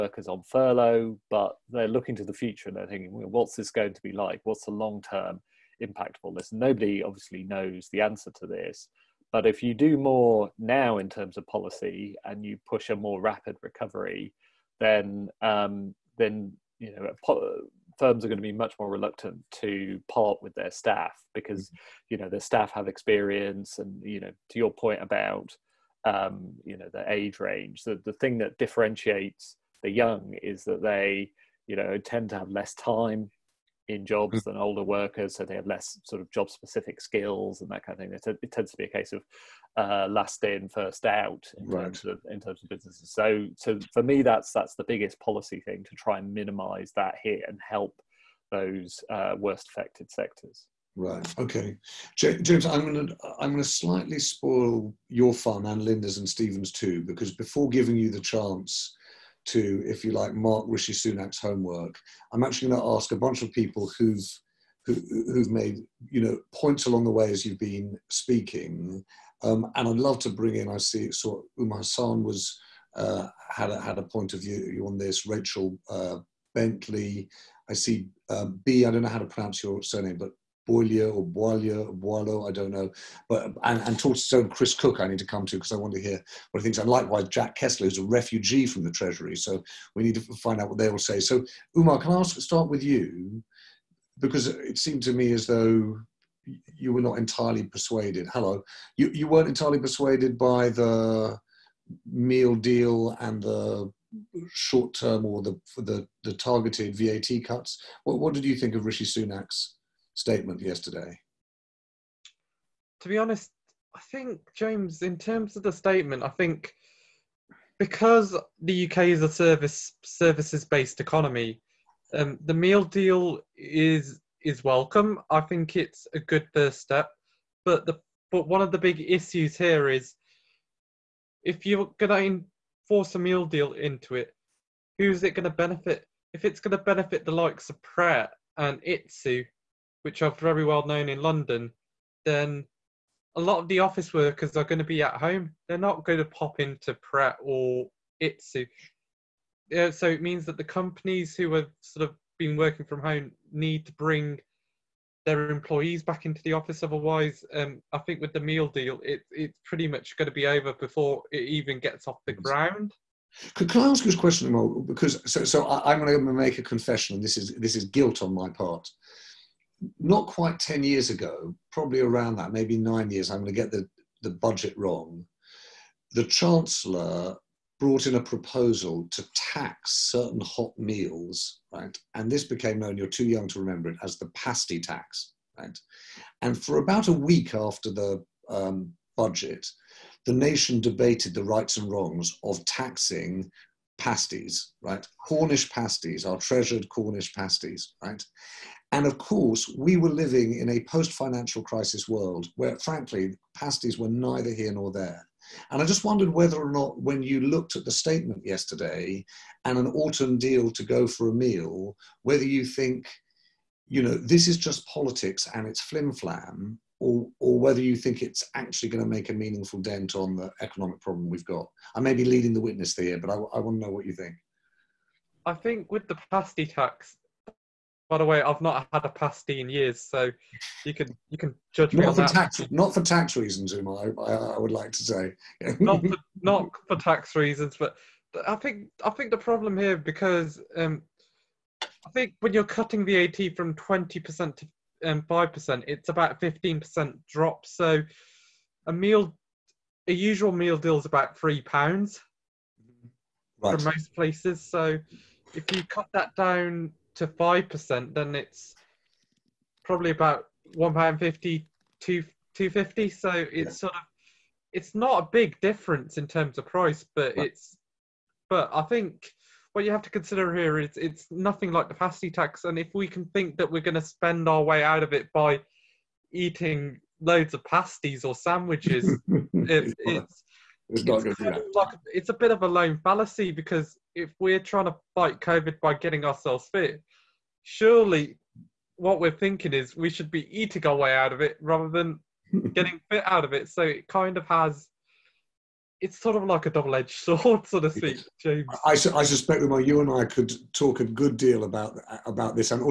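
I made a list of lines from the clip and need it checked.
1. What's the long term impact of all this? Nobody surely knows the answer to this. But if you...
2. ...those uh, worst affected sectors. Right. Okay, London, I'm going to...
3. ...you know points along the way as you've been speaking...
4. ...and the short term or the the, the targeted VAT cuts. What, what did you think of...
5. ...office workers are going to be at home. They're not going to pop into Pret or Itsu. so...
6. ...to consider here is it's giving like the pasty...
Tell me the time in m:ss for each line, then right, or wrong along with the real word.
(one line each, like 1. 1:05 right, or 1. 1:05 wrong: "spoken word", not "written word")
1. 0:04 wrong: "obviously", not "surely"
2. 0:48 wrong: "James", not "London"
3. 1:06 right
4. 1:43 right
5. 2:23 right
6. 4:30 wrong: "nothing", not "giving".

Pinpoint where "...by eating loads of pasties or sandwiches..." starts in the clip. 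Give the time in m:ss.
4:35.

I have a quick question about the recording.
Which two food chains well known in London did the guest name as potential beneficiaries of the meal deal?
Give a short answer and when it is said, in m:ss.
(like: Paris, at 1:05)
Pret and Itsu, at 2:17.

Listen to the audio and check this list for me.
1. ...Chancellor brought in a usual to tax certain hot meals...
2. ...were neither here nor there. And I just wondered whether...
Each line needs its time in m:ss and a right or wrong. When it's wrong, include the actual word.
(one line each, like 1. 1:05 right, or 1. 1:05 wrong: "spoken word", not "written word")
1. 2:56 wrong: "proposal", not "usual"
2. 3:23 right.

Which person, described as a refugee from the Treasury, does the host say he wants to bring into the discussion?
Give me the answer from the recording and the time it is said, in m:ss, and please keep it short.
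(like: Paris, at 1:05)
Jack Kessler, at 1:27.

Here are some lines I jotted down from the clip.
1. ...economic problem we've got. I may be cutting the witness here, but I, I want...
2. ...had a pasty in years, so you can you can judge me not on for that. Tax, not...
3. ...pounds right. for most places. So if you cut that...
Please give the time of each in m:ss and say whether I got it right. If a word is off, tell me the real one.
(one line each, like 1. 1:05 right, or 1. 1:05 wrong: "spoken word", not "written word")
1. 3:40 wrong: "leading", not "cutting"
2. 3:48 right
3. 4:11 right.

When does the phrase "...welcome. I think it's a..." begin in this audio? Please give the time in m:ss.
2:04.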